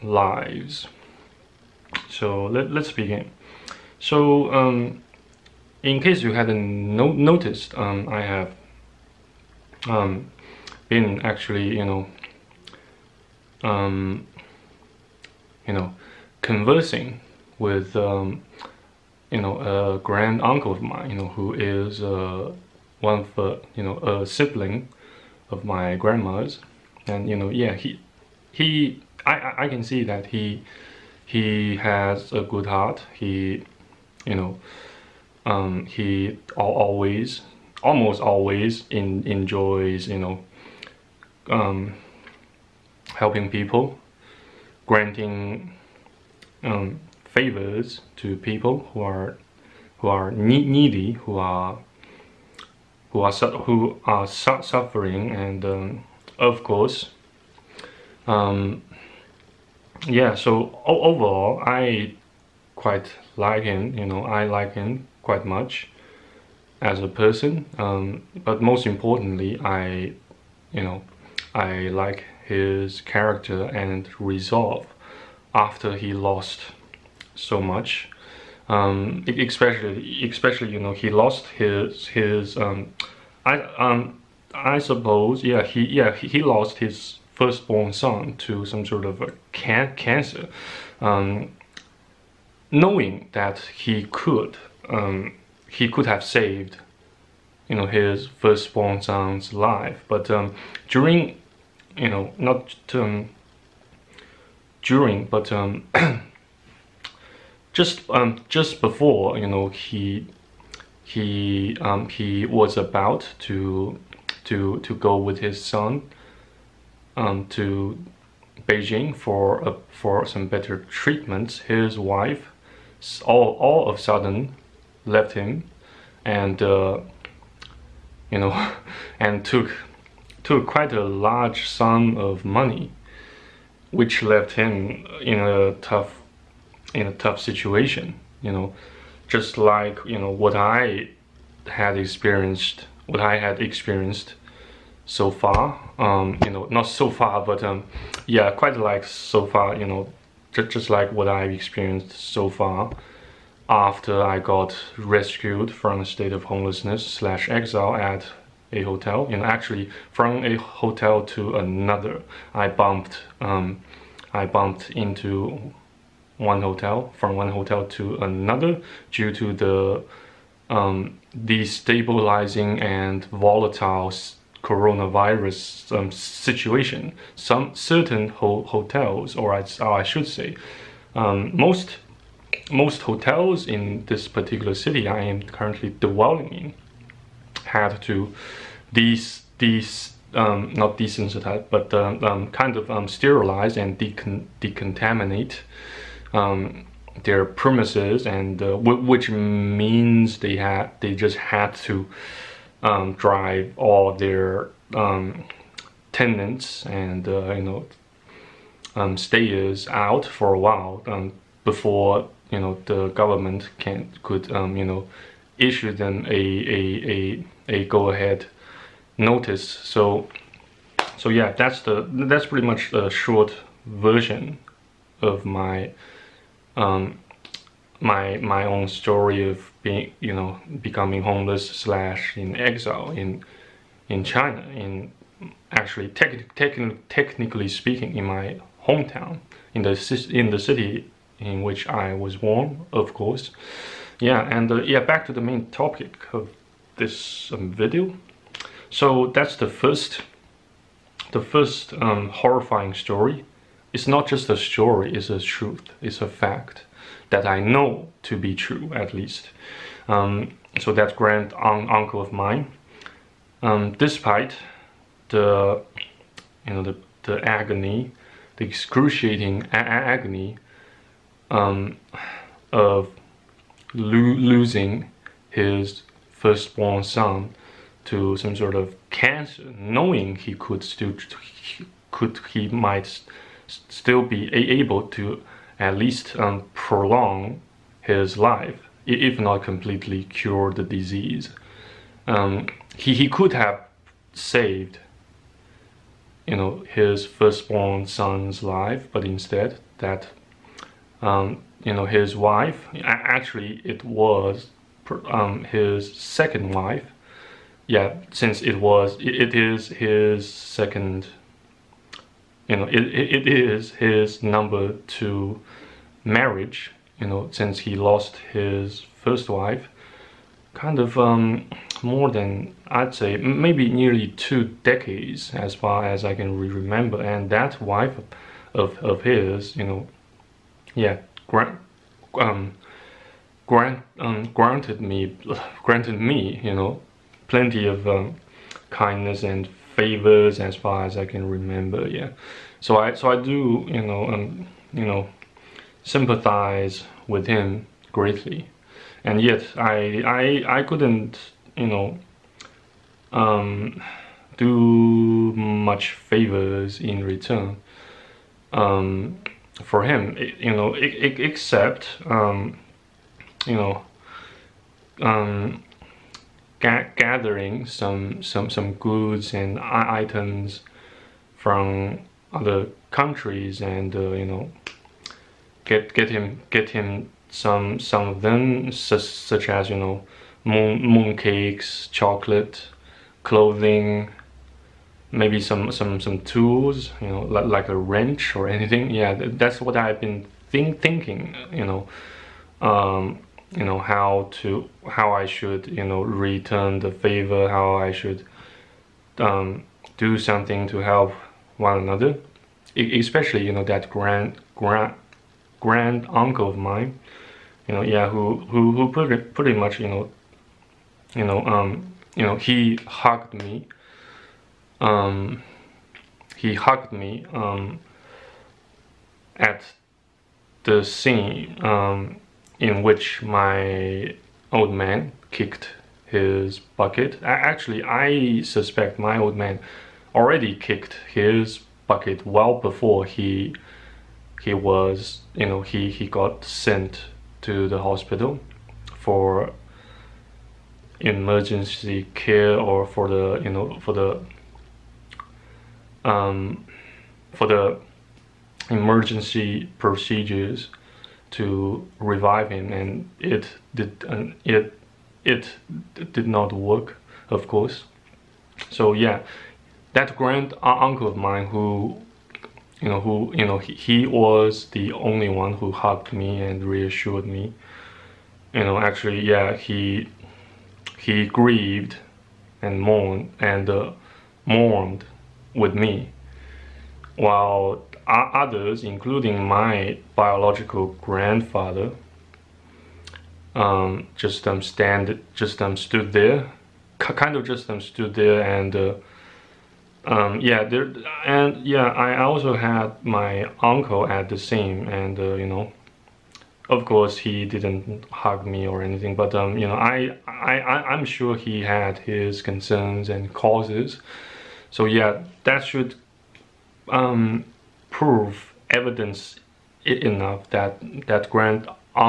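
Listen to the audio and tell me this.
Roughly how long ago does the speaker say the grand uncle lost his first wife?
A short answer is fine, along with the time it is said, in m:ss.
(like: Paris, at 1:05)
nearly two decades, at 5:23.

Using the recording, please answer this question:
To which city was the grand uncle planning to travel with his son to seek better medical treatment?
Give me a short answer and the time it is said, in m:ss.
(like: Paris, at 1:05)
Beijing, at 1:58.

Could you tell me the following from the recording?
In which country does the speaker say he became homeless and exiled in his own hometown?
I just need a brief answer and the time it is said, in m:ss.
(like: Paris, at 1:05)
China, at 3:54.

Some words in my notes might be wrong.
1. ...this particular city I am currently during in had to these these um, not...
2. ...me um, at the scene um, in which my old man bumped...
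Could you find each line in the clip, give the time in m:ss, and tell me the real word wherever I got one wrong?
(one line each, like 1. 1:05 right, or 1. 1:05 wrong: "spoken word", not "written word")
1. 3:04 wrong: "dwelling", not "during"
2. 6:57 wrong: "kicked", not "bumped".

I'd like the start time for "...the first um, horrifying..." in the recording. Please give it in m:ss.
4:11.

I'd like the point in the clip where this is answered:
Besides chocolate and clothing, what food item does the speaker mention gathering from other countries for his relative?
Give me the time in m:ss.
6:21.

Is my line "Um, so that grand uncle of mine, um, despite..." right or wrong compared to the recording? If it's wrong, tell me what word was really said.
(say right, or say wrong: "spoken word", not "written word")
right.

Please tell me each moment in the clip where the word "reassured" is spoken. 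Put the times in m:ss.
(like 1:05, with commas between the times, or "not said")
7:46.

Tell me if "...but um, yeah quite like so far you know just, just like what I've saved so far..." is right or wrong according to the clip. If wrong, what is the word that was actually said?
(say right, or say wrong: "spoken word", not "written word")
wrong: "experienced", not "saved".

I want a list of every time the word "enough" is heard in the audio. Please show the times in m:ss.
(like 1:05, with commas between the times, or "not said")
8:30.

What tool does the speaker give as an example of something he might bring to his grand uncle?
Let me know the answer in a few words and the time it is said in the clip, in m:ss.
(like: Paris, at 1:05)
wrench, at 6:27.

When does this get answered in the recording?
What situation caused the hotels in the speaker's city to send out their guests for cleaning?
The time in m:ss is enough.
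2:54.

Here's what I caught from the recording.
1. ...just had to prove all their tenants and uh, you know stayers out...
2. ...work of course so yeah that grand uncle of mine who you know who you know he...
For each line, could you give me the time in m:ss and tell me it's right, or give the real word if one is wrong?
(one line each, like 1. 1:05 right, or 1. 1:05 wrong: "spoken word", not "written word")
1. 3:21 wrong: "drive", not "prove"
2. 7:36 right.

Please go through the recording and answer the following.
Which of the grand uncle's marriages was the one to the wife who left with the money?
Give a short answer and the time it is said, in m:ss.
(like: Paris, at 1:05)
number two, at 5:14.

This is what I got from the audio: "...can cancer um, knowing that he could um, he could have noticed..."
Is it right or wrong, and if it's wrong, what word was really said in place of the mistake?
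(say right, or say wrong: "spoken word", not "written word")
wrong: "saved", not "noticed".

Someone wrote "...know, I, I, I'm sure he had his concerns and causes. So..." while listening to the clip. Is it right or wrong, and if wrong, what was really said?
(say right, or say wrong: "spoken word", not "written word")
right.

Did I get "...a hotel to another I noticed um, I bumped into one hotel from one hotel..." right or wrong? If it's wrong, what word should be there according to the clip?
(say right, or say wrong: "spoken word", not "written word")
wrong: "bumped", not "noticed".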